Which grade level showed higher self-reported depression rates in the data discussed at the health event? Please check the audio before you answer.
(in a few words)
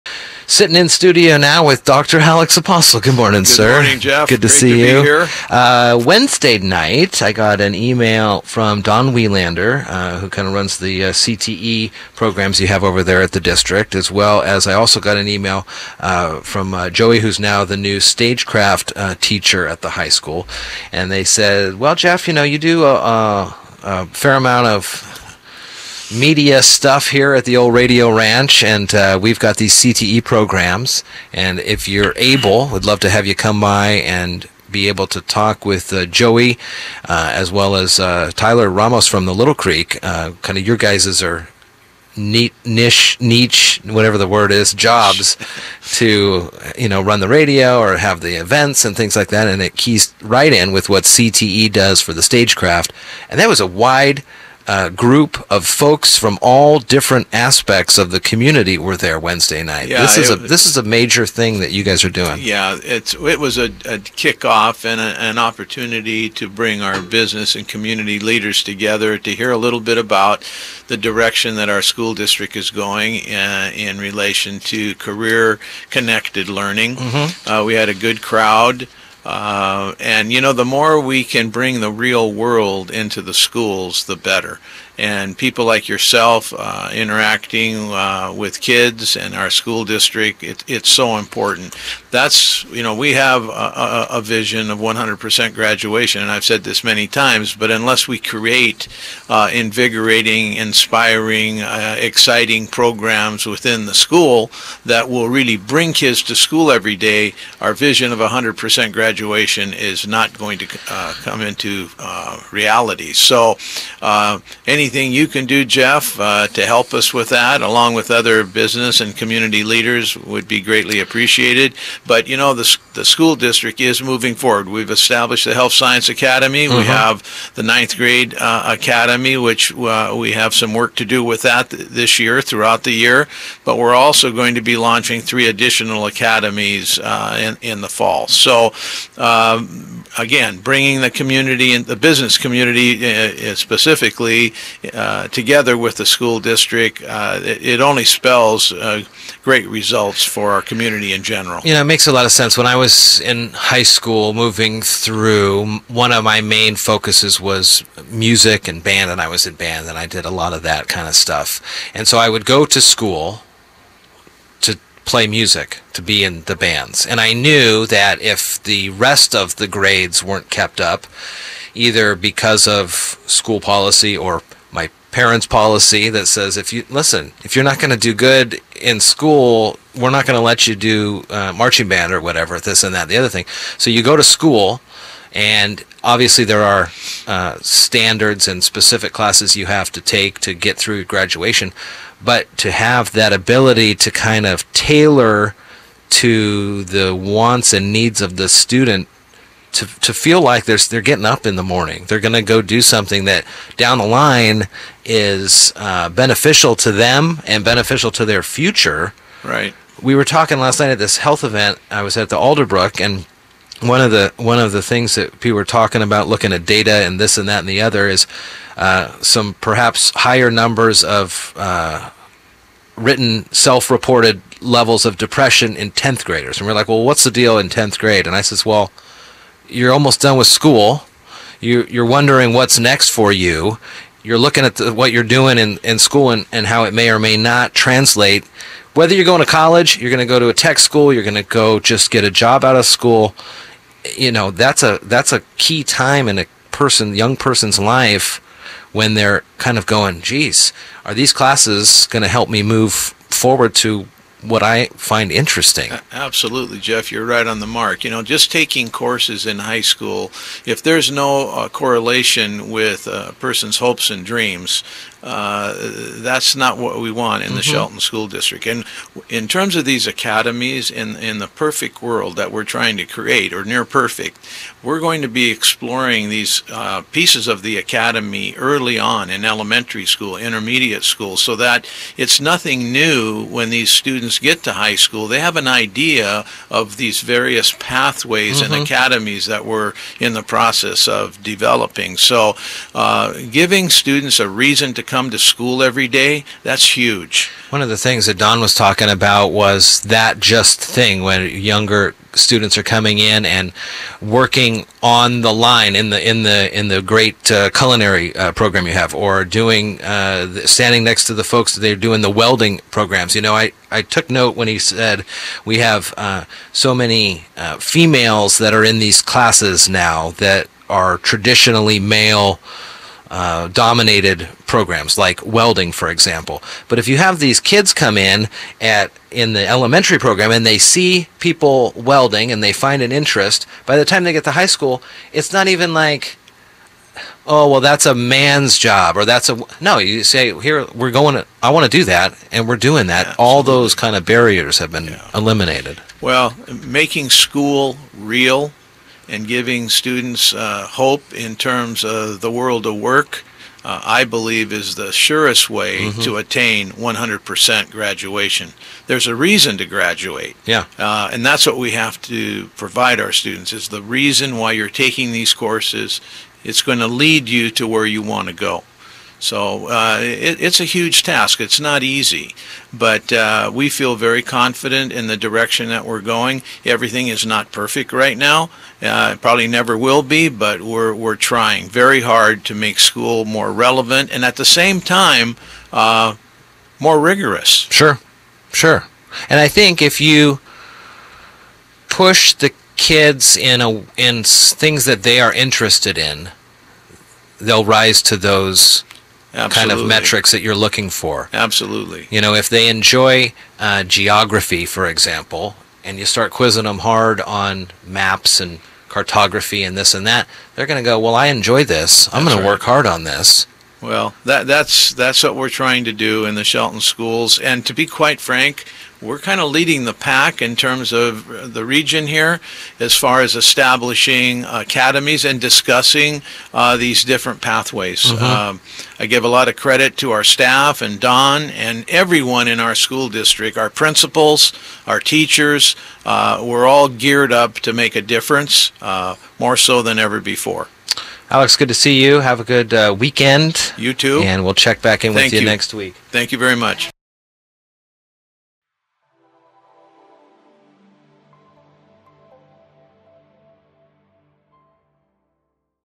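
10th grade.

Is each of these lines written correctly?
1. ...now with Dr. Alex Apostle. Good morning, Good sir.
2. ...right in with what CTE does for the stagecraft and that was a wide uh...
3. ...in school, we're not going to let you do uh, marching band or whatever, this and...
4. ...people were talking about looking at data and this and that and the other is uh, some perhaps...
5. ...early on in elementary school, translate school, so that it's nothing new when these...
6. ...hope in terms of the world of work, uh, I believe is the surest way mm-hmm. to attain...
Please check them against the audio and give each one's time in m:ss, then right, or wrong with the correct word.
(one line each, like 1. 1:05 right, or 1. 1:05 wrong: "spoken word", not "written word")
1. 0:01 right
2. 0:50 right
3. 2:58 right
4. 3:35 right
5. 4:38 wrong: "intermediate", not "translate"
6. 5:50 right.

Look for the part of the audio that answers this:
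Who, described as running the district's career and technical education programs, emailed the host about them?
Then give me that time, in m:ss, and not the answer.
0:08.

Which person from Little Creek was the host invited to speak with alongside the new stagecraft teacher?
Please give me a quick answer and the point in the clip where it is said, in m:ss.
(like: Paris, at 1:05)
Tyler Ramos, at 0:38.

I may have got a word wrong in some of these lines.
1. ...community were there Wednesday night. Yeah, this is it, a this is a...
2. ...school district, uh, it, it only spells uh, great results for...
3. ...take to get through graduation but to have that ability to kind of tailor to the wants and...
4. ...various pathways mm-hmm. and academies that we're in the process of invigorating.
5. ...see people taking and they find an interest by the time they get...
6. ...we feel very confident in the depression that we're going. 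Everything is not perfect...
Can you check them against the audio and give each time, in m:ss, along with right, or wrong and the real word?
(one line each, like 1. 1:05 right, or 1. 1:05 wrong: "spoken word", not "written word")
1. 0:58 right
2. 2:26 right
3. 3:09 right
4. 4:47 wrong: "developing", not "invigorating"
5. 5:30 wrong: "welding", not "taking"
6. 6:13 wrong: "direction", not "depression".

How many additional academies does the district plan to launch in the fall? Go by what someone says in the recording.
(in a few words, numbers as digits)
3.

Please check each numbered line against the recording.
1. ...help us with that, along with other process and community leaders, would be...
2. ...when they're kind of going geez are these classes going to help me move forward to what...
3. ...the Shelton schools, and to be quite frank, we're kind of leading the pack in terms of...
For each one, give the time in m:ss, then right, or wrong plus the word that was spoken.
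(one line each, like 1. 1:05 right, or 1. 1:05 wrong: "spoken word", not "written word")
1. 1:56 wrong: "business", not "process"
2. 4:08 right
3. 6:56 right.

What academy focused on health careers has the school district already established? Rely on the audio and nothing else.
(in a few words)
Health Science Academy.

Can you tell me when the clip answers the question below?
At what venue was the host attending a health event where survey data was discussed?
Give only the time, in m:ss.
3:32.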